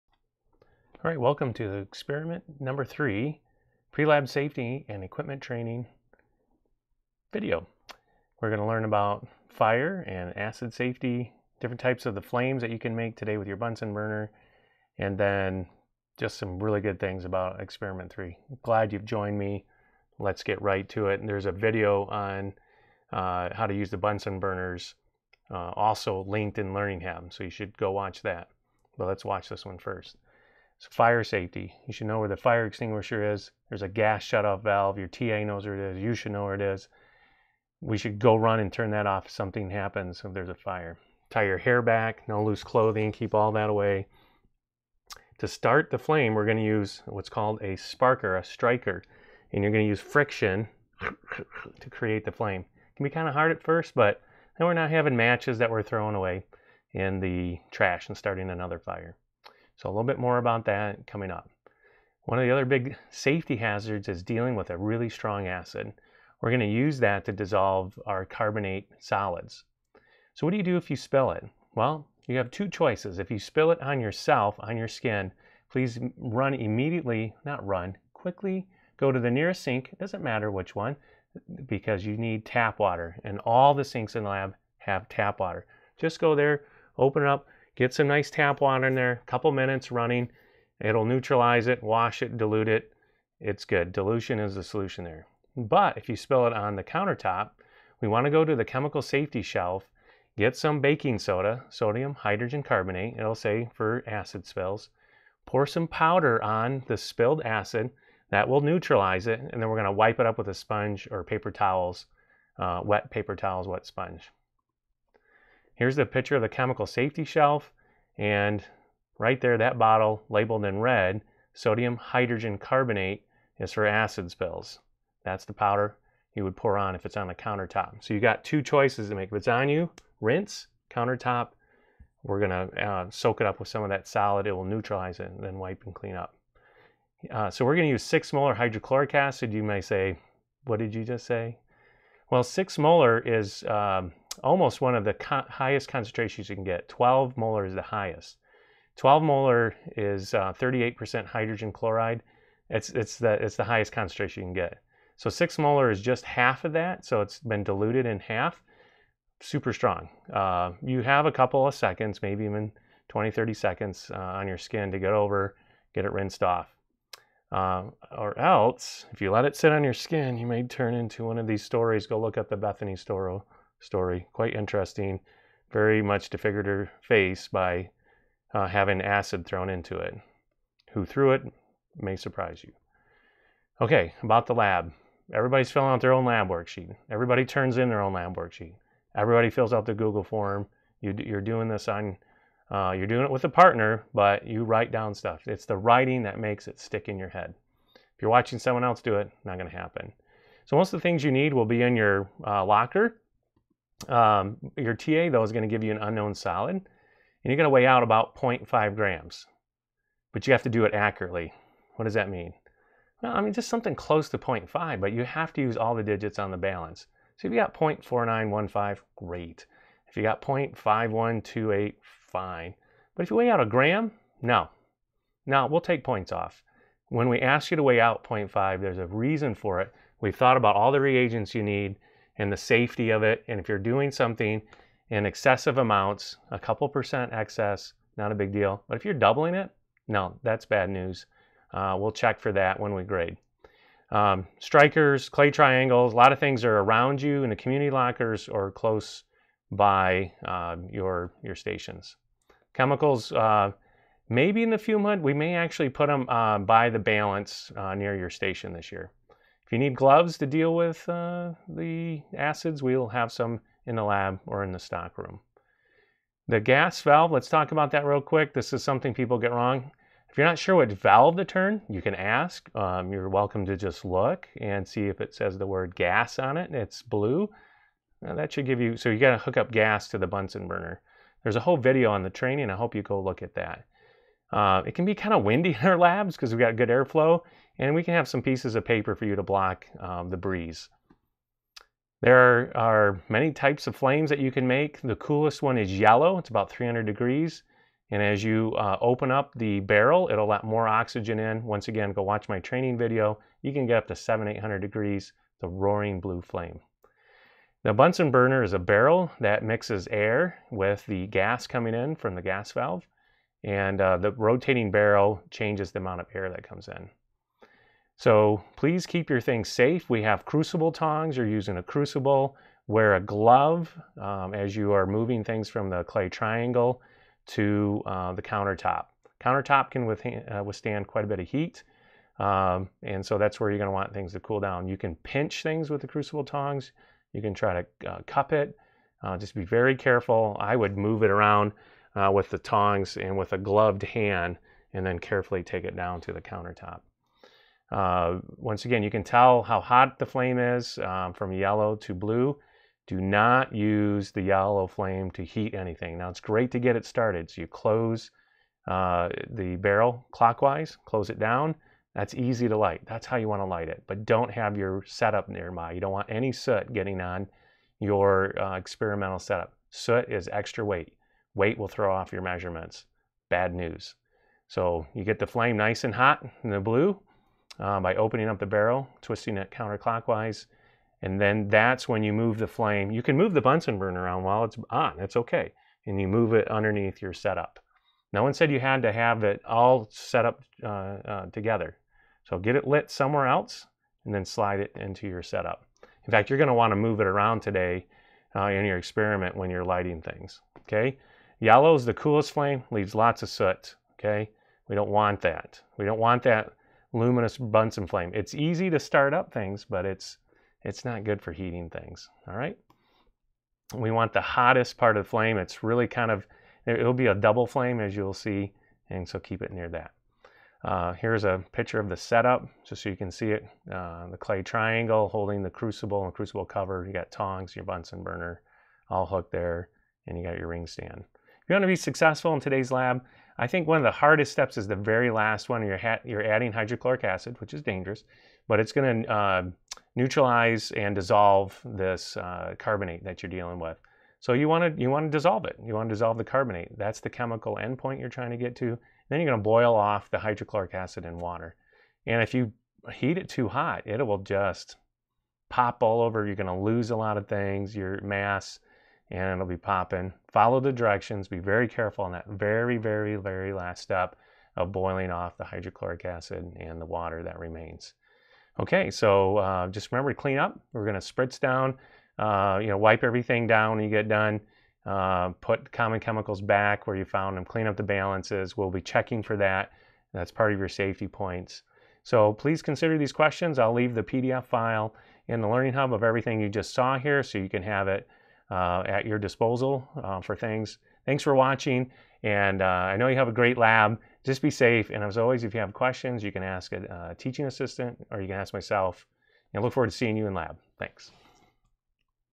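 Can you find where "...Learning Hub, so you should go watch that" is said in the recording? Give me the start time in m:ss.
0:26.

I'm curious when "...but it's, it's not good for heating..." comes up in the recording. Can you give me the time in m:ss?
6:49.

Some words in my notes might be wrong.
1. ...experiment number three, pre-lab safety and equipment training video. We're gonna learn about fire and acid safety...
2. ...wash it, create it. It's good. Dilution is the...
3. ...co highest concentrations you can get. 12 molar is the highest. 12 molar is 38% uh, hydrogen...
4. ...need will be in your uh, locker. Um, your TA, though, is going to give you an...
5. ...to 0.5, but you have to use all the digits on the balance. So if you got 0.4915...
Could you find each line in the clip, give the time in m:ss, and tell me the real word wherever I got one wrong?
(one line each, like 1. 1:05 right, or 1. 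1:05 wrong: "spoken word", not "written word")
1. 0:01 right
2. 1:31 wrong: "dilute", not "create"
3. 2:25 right
4. 3:21 right
5. 3:34 right.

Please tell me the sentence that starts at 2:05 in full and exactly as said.
That's the powder you would pour on if it's on the countertop.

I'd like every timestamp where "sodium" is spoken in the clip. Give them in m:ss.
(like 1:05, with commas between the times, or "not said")
1:41, 2:01.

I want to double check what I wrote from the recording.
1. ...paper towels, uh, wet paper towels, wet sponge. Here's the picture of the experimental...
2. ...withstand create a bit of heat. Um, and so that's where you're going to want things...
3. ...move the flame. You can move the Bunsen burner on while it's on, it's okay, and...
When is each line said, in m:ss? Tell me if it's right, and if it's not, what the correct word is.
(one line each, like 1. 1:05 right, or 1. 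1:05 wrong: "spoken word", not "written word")
1. 1:51 wrong: "chemical", not "experimental"
2. 5:30 wrong: "quite", not "create"
3. 6:22 right.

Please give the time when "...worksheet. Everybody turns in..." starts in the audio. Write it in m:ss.
3:06.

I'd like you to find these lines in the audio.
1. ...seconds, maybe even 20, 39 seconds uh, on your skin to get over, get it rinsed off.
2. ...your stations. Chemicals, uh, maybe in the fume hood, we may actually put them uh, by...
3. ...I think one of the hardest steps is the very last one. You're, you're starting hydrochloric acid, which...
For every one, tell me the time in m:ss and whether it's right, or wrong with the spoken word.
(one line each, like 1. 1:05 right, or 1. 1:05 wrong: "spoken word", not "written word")
1. 2:41 wrong: "30", not "39"
2. 4:11 right
3. 7:13 wrong: "adding", not "starting".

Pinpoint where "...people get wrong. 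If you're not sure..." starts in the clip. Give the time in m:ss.
4:29.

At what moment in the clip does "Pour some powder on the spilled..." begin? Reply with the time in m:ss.
1:45.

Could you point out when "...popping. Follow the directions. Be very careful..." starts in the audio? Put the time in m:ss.
7:39.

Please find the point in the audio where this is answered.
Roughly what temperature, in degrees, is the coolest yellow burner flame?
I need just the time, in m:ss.
4:56.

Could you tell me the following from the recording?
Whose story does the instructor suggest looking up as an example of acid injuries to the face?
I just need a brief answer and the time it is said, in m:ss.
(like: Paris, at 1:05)
Bethany Storro, at 2:52.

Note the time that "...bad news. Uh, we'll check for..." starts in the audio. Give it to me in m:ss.
4:00.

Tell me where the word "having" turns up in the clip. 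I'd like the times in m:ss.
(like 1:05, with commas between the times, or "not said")
0:54, 2:58.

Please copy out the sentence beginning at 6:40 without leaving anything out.
Okay, yellow is the coolest flame, leaves lots of soot.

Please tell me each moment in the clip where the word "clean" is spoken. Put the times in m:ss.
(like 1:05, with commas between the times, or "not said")
2:15, 7:50, 7:57.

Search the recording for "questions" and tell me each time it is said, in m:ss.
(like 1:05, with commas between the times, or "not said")
8:03, 8:15.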